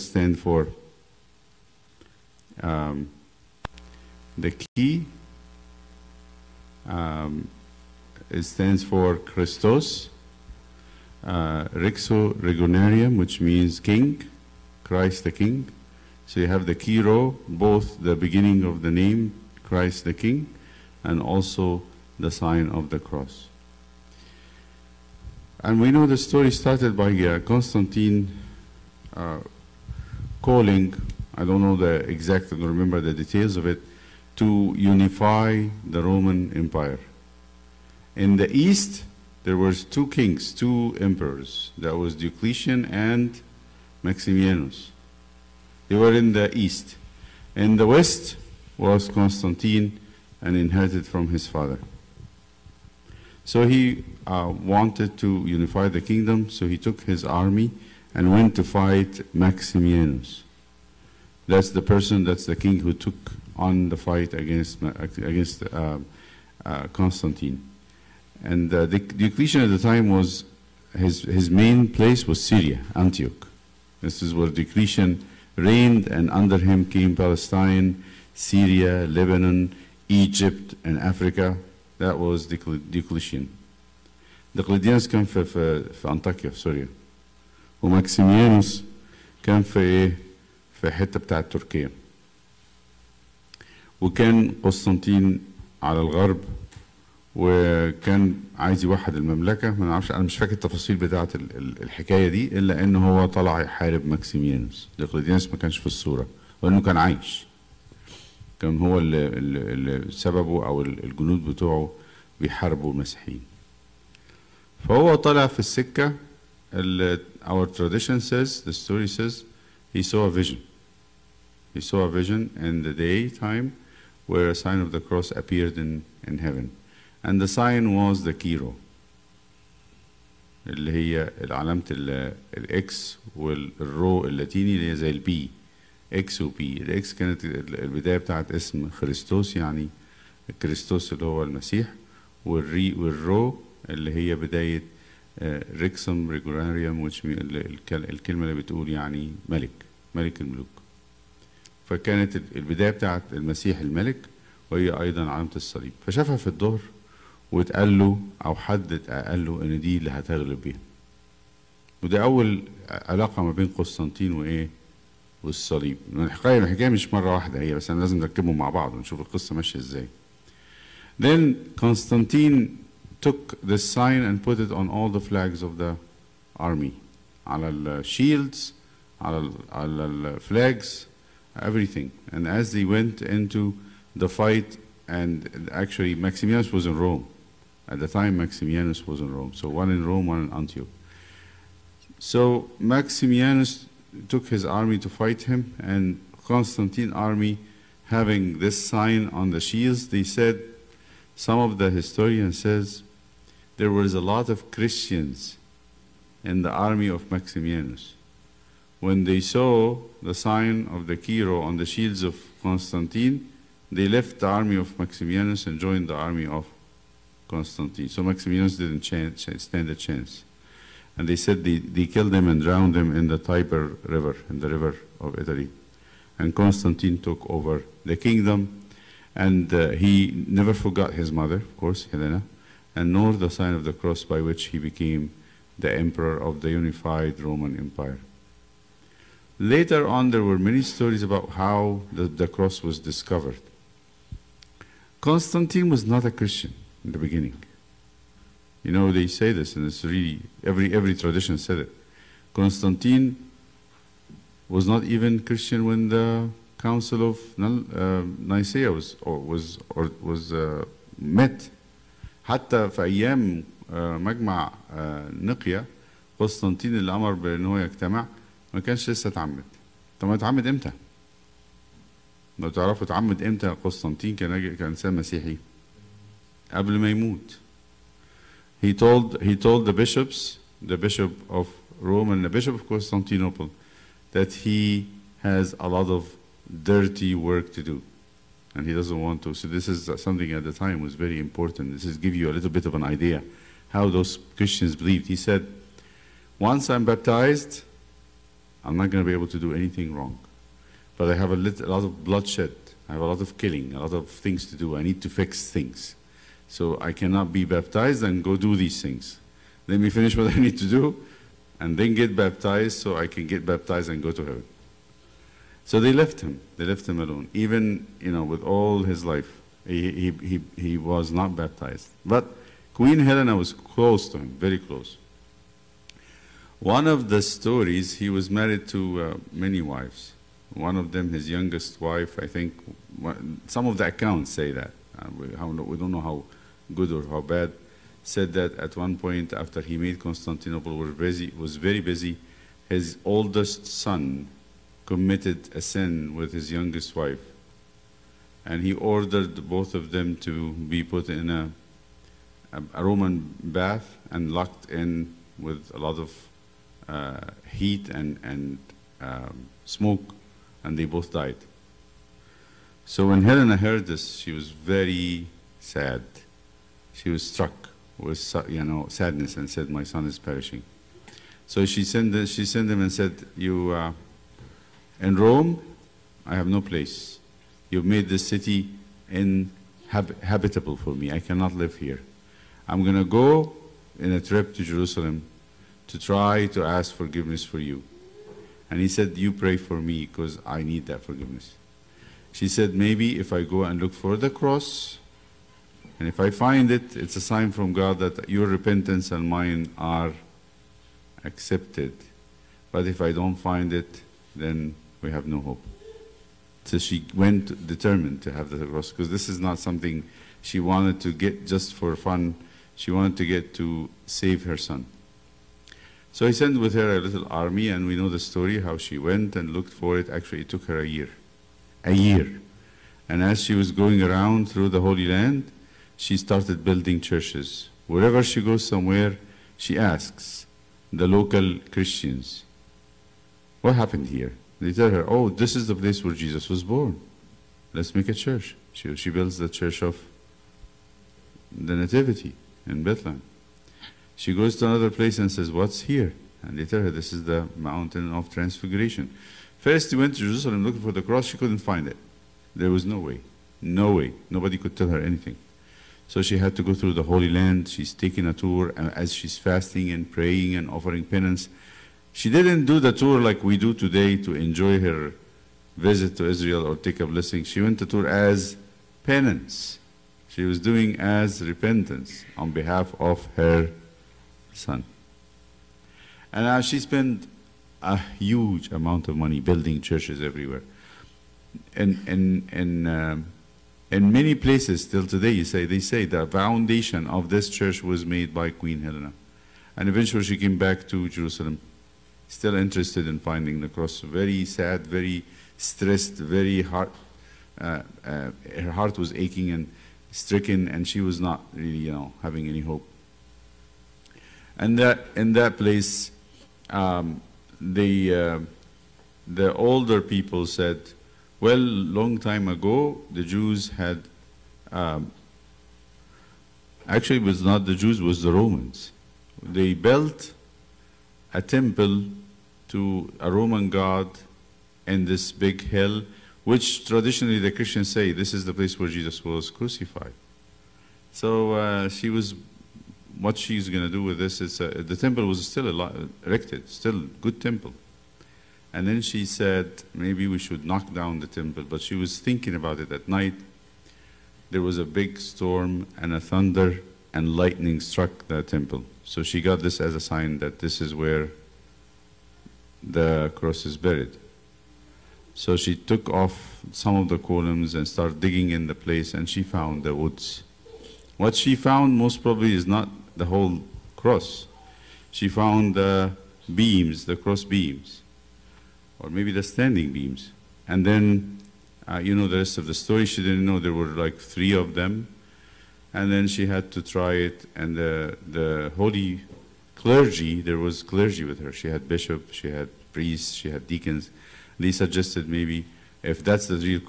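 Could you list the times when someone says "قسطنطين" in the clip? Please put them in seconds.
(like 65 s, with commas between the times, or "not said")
94 s, 163 s, 171 s, 266 s, 273 s.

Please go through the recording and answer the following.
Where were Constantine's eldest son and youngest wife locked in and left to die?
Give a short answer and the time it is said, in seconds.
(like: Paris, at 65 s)
A Roman bath, at 353 s.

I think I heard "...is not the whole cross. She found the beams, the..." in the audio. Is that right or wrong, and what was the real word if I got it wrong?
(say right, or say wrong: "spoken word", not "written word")
right.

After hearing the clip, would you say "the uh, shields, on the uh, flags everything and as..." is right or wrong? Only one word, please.
right.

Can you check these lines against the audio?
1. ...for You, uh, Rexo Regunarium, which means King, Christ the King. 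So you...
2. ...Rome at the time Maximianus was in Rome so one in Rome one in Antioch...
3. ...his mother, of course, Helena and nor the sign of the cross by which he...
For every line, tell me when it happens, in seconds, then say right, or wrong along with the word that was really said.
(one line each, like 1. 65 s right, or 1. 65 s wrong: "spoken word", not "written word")
1. 8 s wrong: "Christos", not "You"
2. 187 s right
3. 231 s right.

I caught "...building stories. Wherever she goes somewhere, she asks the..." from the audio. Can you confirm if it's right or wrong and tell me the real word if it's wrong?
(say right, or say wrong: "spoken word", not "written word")
wrong: "churches", not "stories".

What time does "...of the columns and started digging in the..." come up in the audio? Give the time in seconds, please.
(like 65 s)
557 s.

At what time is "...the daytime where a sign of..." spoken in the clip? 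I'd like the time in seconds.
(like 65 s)
122 s.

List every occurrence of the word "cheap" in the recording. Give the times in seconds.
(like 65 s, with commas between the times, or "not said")
not said.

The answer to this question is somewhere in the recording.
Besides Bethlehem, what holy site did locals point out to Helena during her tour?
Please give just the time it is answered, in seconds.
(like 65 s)
447 s.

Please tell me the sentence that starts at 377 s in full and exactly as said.
You've made this city inhabitable for me.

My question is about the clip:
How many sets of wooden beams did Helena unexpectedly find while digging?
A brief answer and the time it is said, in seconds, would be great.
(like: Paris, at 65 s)
3, at 574 s.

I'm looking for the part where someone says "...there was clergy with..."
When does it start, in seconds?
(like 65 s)
580 s.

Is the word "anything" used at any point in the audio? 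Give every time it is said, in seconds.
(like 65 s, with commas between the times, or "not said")
299 s, 455 s.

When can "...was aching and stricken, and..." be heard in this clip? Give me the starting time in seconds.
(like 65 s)
499 s.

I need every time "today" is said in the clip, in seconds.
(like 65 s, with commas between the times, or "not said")
463 s, 485 s.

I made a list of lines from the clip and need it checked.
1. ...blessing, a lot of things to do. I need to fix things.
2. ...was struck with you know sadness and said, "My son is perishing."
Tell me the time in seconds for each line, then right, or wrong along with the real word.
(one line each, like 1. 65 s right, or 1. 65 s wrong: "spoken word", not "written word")
1. 303 s wrong: "killing", not "blessing"
2. 367 s right.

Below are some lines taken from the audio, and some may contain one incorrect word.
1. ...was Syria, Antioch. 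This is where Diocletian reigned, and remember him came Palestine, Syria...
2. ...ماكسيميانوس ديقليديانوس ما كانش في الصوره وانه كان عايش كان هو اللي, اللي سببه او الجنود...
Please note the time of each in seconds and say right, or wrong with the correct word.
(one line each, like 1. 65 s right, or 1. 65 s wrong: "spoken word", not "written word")
1. 72 s wrong: "under", not "remember"
2. 104 s right.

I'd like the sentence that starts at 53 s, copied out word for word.
So he uh, wanted to unify the kingdom, so he took his army and went to fight Maximianus.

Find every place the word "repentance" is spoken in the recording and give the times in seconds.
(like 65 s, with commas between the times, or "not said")
398 s, 471 s.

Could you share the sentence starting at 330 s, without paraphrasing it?
One of them, his youngest wife, I think, some of the accounts say that.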